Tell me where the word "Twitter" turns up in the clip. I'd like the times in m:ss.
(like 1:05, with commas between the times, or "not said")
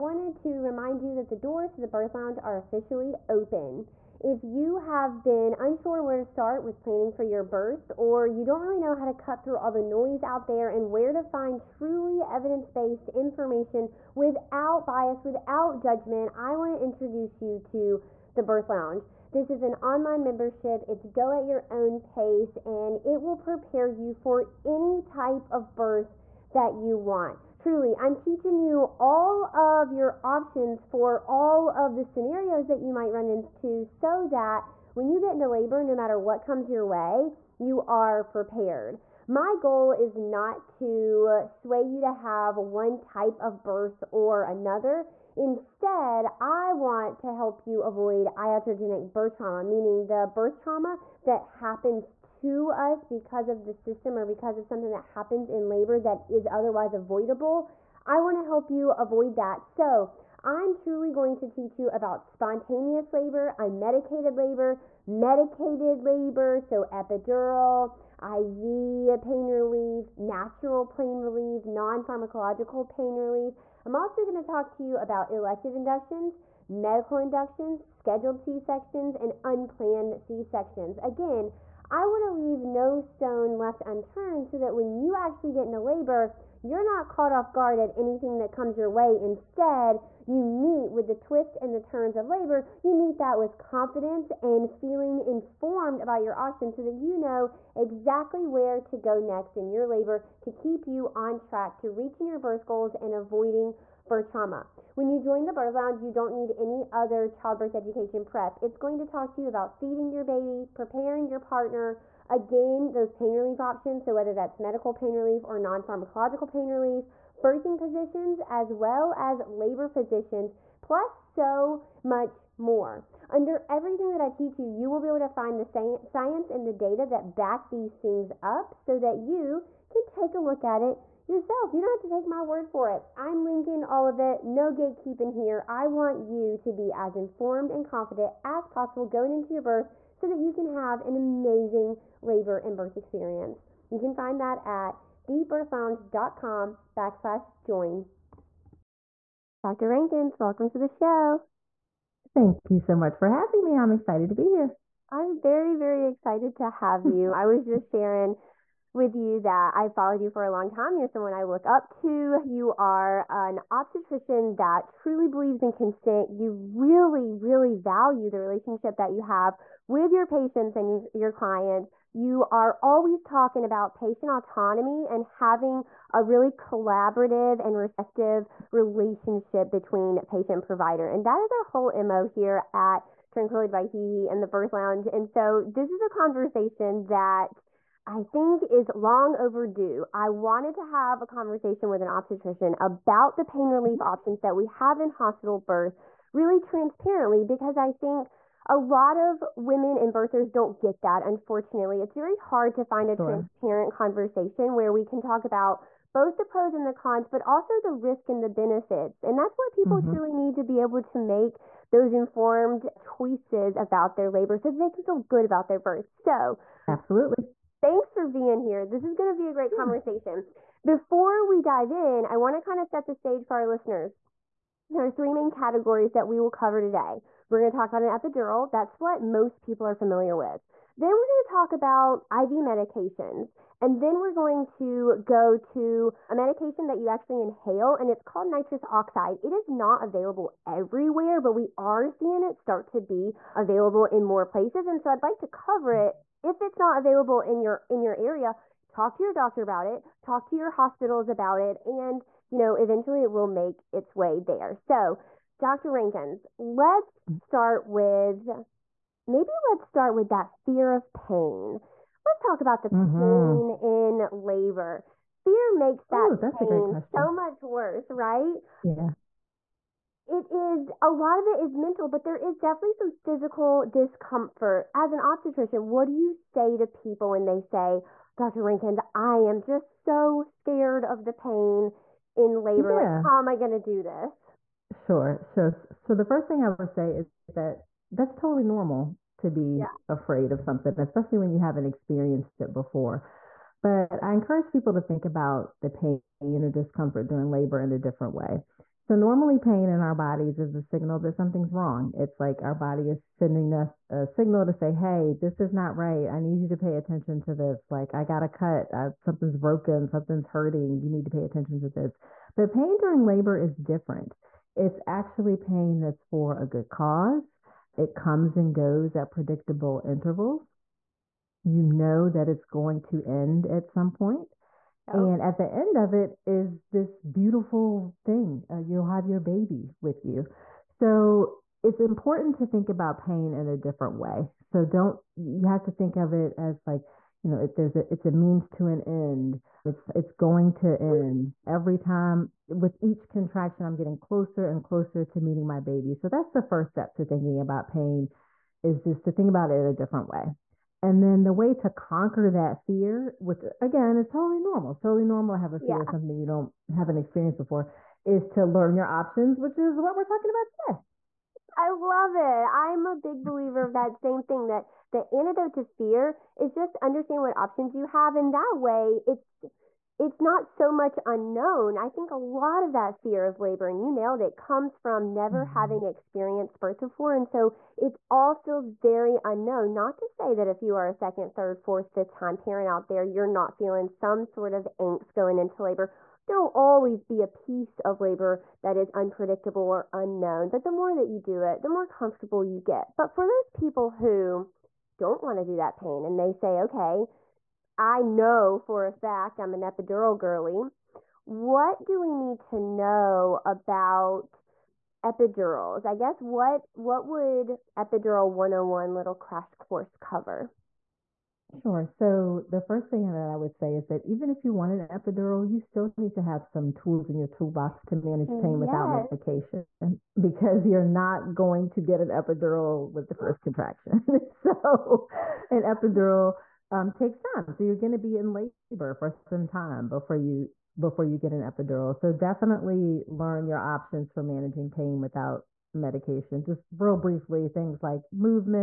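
not said.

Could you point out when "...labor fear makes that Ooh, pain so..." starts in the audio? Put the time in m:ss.
4:24.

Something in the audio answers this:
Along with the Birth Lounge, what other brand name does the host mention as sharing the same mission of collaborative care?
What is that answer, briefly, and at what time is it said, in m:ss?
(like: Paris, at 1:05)
Tranquility by Hee Hee, at 3:03.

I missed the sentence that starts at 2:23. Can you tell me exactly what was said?
You can find that at thebirthlounge.com backslash join.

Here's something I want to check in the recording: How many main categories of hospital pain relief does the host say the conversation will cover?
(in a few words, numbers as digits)
3.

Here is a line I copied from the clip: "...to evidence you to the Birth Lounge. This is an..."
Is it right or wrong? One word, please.
wrong.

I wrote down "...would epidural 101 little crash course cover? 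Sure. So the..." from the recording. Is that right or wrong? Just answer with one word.
right.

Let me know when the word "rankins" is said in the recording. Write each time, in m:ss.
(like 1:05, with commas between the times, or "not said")
2:29, 4:15, 4:38.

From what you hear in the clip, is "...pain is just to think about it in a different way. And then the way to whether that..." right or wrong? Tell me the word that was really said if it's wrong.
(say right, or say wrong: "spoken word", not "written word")
wrong: "conquer", not "whether".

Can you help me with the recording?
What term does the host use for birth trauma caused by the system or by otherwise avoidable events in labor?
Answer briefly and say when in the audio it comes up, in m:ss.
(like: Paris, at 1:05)
iatrogenic birth trauma, at 0:48.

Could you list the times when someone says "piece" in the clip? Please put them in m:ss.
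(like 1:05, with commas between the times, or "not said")
6:27.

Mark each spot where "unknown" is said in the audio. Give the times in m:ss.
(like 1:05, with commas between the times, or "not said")
6:11, 6:19, 6:30.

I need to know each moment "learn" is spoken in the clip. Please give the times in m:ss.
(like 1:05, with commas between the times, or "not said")
5:58, 7:13.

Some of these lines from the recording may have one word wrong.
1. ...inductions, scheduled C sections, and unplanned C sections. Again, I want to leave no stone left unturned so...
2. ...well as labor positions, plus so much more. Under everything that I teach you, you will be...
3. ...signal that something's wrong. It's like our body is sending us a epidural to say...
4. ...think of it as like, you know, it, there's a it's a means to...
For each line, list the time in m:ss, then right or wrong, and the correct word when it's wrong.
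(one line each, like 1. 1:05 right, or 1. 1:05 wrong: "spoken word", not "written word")
1. 1:17 right
2. 1:58 right
3. 5:00 wrong: "signal", not "epidural"
4. 5:35 right.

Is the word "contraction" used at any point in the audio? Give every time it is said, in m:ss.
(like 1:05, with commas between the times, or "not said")
5:43, 7:03.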